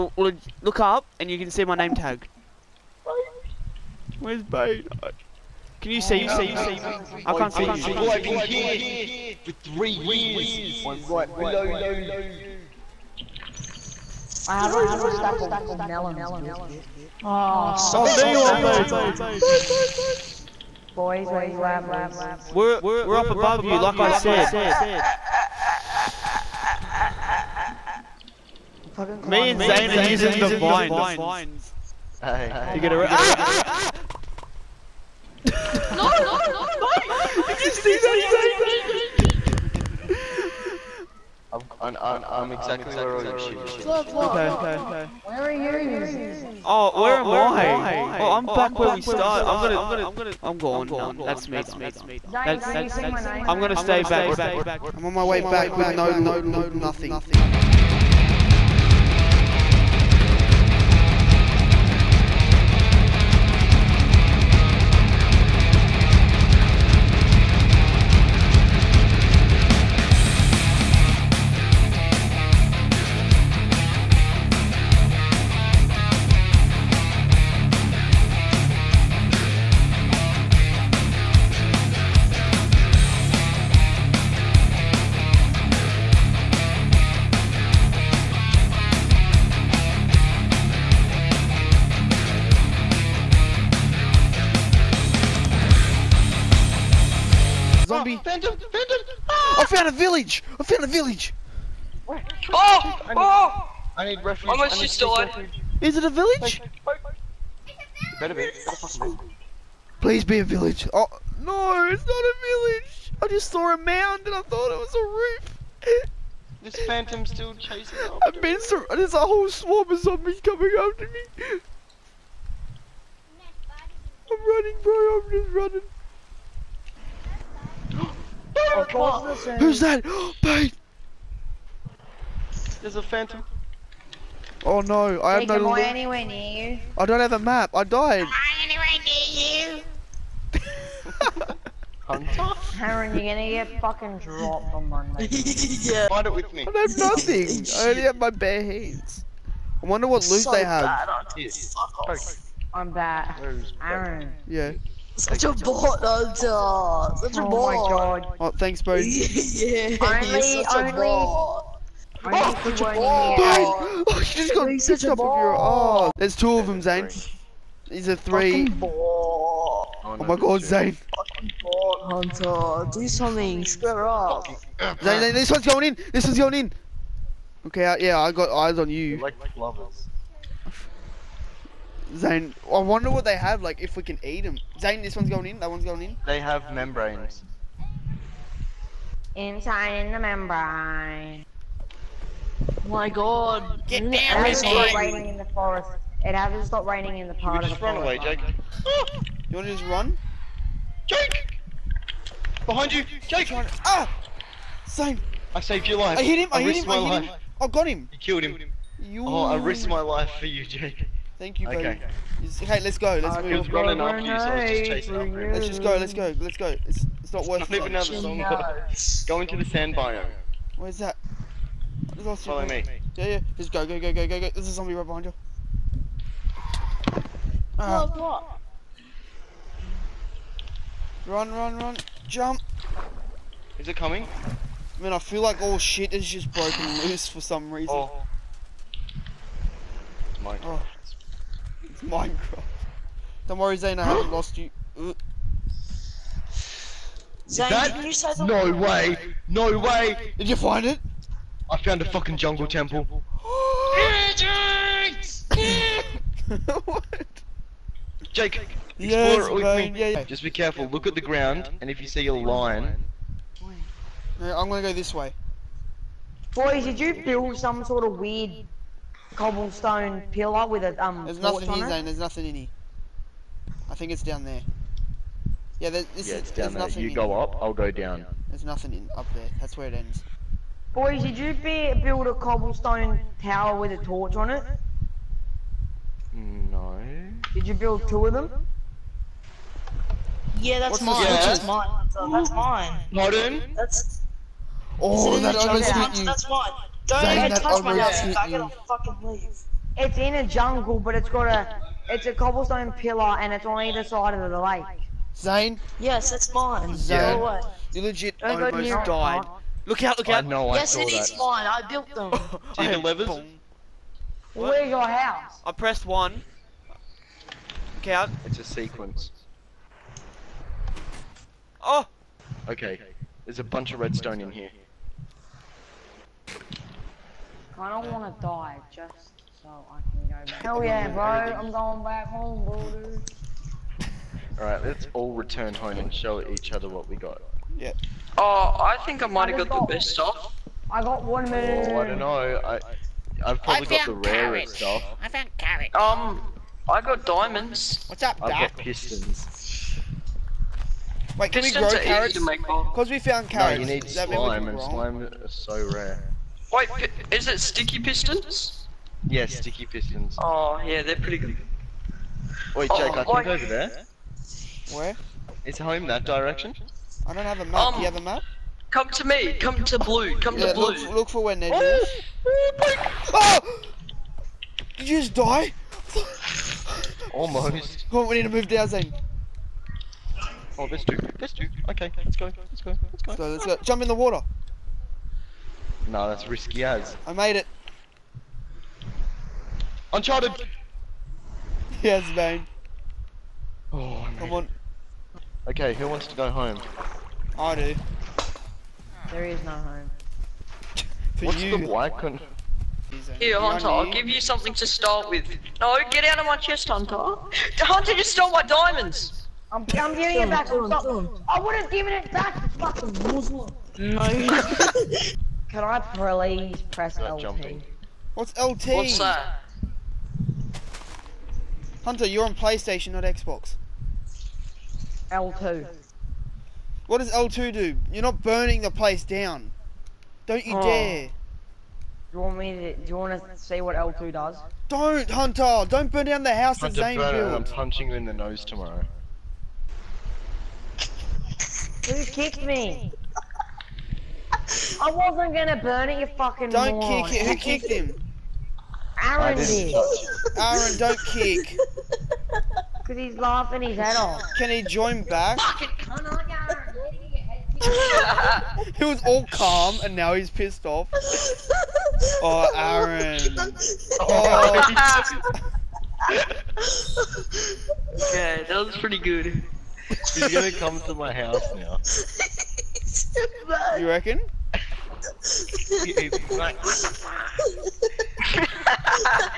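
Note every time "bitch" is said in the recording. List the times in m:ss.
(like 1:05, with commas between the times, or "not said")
0:16.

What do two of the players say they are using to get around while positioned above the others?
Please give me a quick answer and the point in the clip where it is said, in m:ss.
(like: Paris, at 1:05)
the vines, at 0:30.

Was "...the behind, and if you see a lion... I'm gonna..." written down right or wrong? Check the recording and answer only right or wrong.
wrong.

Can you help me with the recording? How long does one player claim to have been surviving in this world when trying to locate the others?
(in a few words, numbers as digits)
3 years.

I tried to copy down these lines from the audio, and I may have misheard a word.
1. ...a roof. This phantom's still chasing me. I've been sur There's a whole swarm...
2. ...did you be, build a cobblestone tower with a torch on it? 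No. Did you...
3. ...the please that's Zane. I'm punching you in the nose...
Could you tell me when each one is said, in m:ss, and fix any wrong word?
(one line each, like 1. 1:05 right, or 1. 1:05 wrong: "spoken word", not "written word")
1. 1:54 right
2. 4:41 right
3. 7:16 wrong: "house", not "please".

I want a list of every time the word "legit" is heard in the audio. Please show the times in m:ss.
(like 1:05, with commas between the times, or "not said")
5:08.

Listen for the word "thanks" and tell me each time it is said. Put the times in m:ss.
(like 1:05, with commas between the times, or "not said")
2:38, 3:31.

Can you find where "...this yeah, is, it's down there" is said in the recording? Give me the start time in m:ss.
4:36.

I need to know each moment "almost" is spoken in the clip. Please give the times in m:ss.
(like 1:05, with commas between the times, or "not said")
1:44, 5:08, 6:17.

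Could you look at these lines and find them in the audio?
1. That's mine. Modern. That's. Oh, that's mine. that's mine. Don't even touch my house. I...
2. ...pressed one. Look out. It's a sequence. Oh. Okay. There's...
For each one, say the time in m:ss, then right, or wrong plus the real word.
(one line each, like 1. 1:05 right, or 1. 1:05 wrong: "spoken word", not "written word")
1. 4:52 right
2. 5:15 right.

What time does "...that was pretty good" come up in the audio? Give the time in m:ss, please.
7:48.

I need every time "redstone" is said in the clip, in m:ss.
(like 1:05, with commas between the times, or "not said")
5:23.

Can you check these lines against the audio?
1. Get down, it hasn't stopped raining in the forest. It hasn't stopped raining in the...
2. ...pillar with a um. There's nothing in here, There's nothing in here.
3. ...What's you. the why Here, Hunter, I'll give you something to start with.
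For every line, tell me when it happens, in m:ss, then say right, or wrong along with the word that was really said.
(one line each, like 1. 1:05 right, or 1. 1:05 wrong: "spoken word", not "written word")
1. 3:13 right
2. 4:30 right
3. 6:41 right.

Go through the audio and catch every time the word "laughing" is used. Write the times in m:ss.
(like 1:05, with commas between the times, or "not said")
7:33.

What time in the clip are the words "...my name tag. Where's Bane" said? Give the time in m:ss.
0:01.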